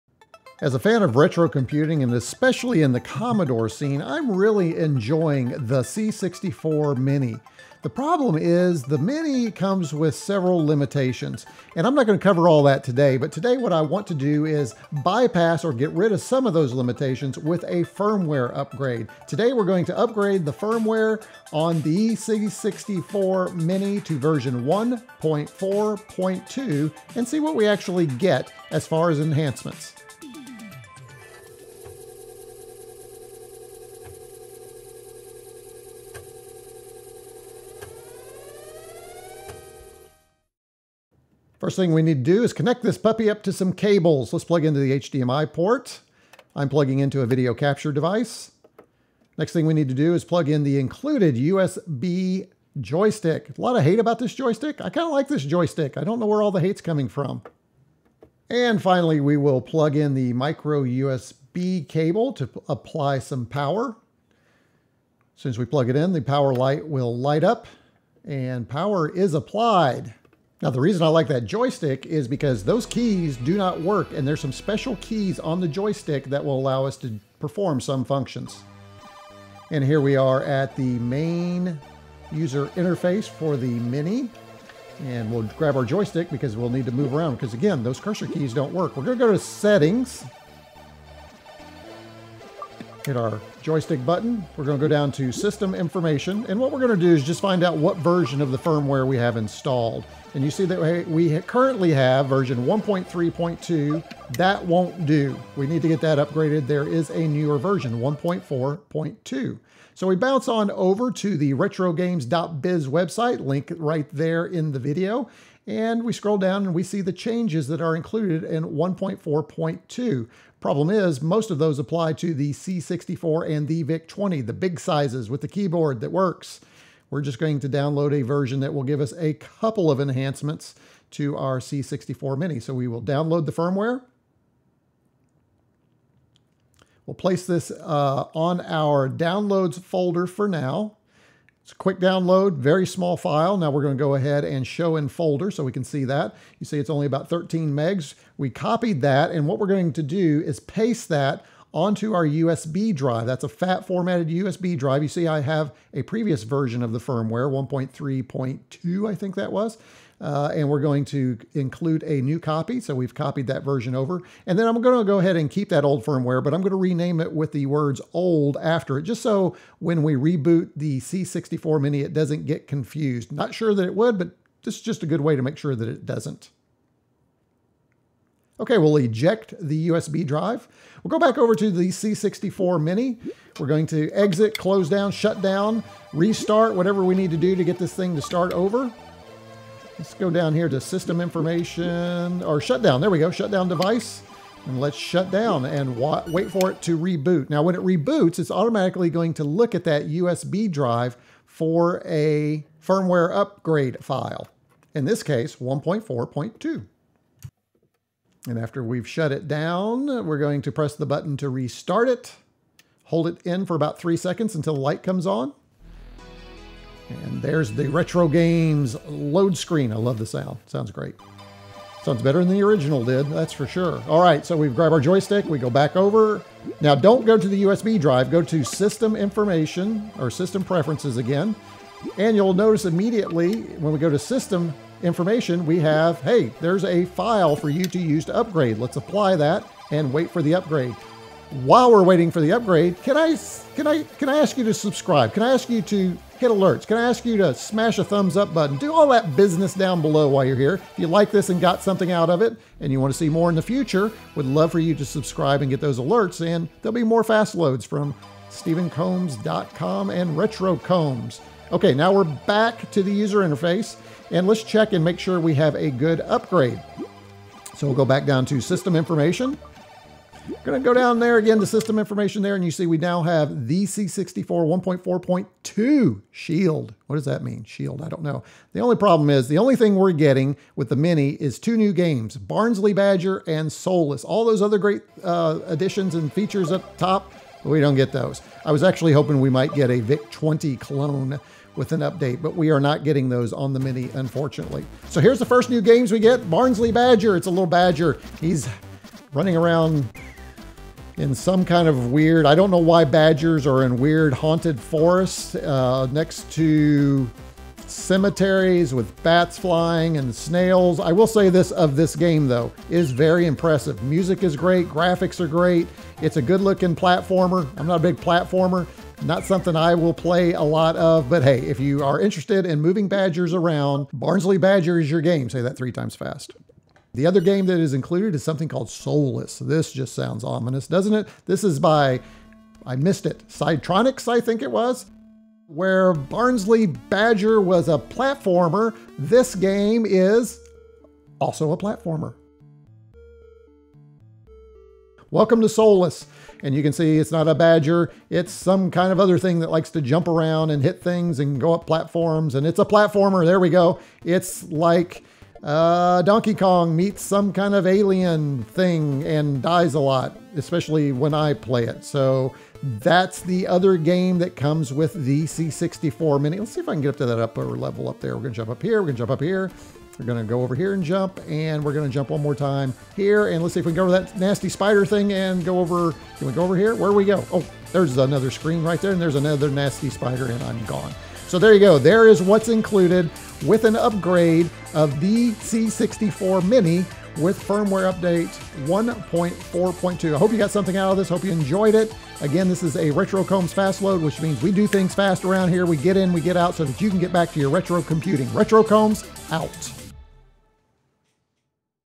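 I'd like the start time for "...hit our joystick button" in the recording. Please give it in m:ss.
1:33.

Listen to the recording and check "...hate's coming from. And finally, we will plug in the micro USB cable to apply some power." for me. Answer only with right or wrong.
right.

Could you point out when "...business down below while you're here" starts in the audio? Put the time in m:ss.
4:09.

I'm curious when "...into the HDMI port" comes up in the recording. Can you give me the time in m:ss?
0:44.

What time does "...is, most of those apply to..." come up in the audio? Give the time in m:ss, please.
2:00.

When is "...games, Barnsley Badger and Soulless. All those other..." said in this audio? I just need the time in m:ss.
4:41.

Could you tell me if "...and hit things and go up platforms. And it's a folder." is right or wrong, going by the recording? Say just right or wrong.
wrong.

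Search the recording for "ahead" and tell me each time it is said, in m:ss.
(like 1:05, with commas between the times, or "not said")
2:24, 2:45.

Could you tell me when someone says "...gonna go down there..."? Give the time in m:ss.
4:30.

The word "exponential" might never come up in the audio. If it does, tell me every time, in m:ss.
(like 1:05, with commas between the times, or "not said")
not said.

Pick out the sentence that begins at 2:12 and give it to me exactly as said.
So we will download the firmware.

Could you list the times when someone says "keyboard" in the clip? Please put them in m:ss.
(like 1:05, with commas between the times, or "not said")
2:05.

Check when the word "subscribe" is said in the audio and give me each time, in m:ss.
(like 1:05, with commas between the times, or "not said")
4:04, 4:15.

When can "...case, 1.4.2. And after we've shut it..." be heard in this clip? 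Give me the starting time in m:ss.
3:25.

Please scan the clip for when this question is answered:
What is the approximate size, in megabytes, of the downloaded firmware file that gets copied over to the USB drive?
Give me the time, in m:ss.
2:27.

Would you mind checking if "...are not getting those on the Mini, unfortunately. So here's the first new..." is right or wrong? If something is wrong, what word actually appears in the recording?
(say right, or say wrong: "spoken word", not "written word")
right.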